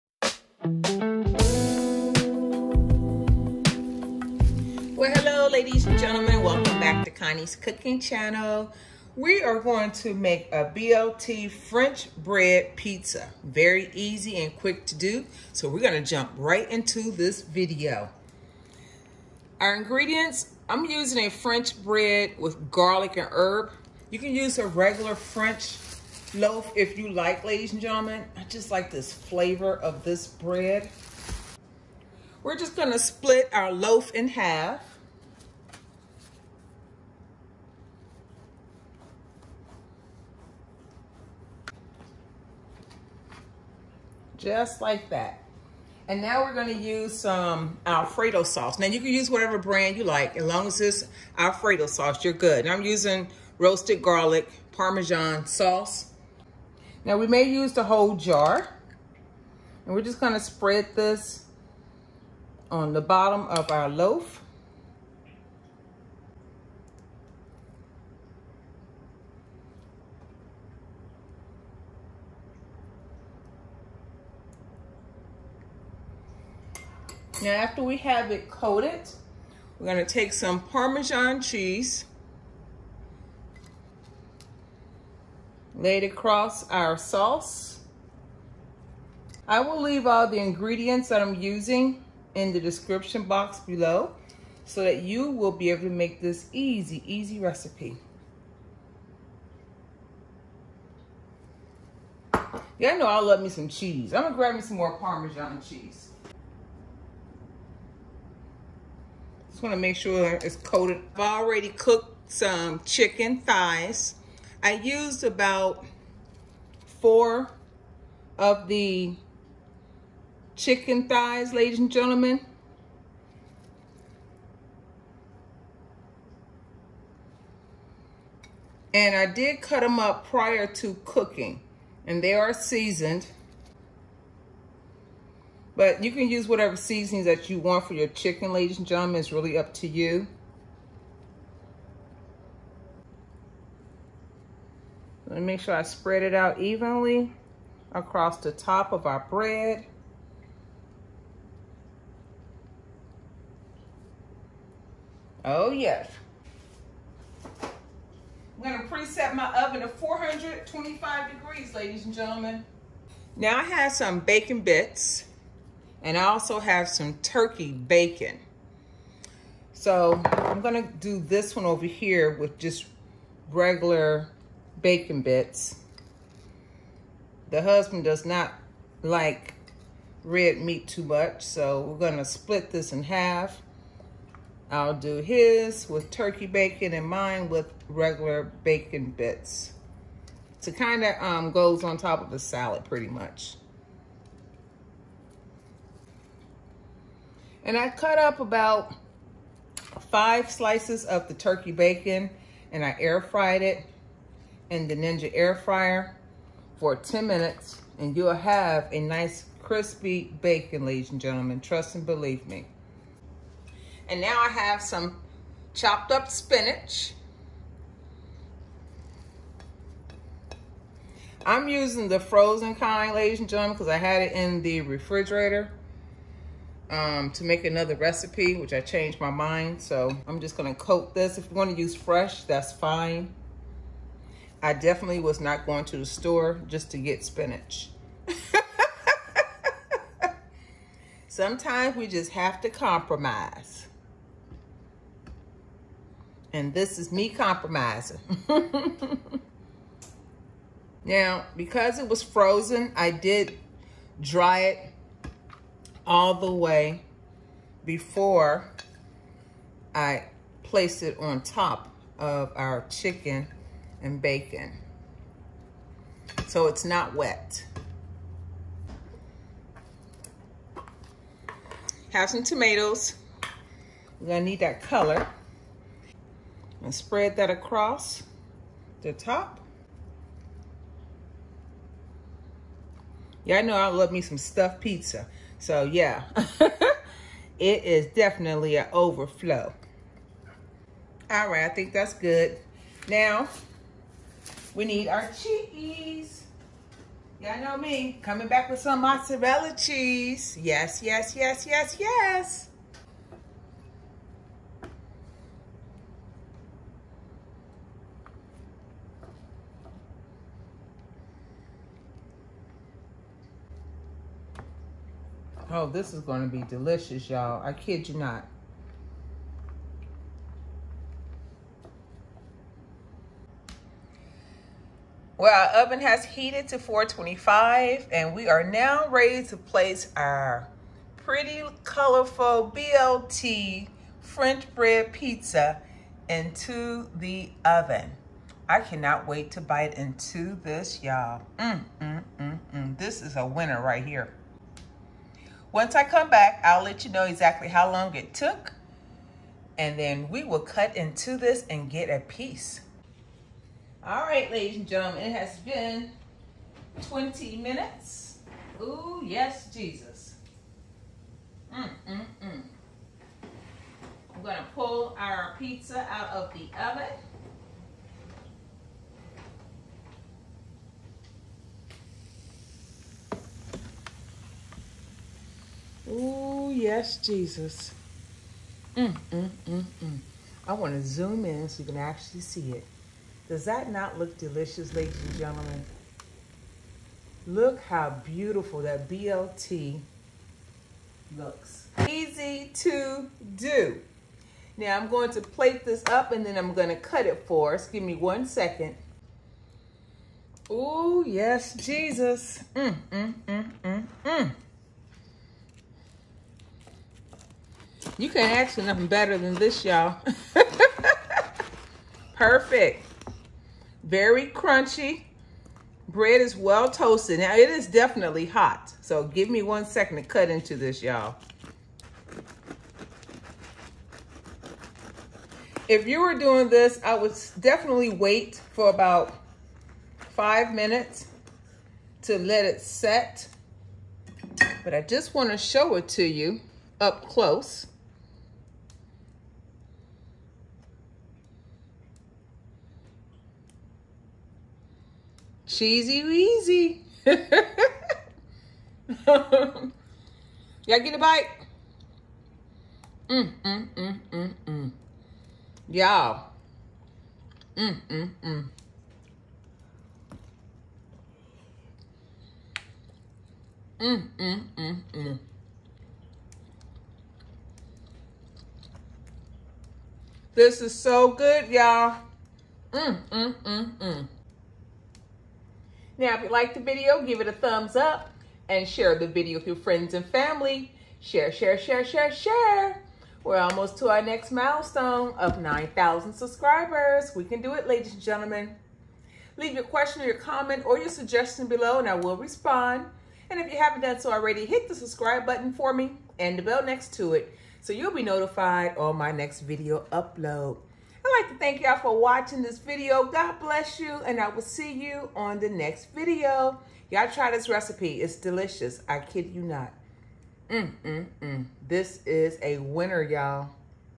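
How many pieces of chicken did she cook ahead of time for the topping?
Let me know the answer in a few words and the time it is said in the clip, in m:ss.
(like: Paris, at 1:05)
4, at 1:56.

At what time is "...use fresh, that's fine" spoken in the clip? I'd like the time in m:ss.
3:51.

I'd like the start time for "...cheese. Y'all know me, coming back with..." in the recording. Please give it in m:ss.
4:55.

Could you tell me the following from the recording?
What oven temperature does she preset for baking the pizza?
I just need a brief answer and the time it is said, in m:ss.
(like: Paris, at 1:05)
425 degrees, at 2:39.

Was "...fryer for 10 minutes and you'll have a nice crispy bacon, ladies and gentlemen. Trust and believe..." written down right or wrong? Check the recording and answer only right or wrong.
right.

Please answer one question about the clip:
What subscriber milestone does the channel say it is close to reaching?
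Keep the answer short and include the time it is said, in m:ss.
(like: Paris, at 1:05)
9,000, at 8:05.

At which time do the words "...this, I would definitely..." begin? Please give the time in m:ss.
7:06.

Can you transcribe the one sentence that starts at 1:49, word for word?
Just wanna make sure it's coated.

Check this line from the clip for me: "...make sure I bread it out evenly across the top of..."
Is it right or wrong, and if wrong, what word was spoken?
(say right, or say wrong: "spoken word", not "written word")
wrong: "spread", not "bread".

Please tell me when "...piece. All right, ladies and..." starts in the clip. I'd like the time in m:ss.
5:52.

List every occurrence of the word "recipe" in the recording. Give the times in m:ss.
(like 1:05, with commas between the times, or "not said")
1:37, 3:47, 8:27.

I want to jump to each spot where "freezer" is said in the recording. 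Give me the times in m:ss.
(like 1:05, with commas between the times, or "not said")
not said.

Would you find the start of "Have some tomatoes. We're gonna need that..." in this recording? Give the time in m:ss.
4:32.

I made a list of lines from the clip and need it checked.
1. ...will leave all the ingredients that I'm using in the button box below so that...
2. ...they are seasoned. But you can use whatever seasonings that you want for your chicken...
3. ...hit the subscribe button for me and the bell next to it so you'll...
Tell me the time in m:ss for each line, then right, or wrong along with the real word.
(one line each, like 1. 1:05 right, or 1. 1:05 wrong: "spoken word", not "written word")
1. 1:29 wrong: "description", not "button"
2. 2:12 right
3. 8:14 right.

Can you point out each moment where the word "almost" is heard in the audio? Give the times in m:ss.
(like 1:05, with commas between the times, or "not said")
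8:03.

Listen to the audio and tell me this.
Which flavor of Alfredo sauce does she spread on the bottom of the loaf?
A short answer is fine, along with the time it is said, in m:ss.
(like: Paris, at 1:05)
Roasted garlic Parmesan, at 0:53.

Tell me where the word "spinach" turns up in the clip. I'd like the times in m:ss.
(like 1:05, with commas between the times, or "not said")
3:36, 3:57.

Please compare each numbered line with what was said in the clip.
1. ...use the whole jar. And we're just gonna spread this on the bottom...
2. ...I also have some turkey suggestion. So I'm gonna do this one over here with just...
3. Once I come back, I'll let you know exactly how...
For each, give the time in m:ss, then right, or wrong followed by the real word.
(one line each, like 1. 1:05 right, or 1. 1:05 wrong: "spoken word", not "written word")
1. 0:57 right
2. 2:46 wrong: "bacon", not "suggestion"
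3. 5:45 right.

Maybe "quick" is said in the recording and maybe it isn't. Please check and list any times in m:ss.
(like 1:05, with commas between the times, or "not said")
0:14.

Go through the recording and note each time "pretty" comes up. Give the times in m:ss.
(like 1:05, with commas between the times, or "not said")
3:12, 5:31.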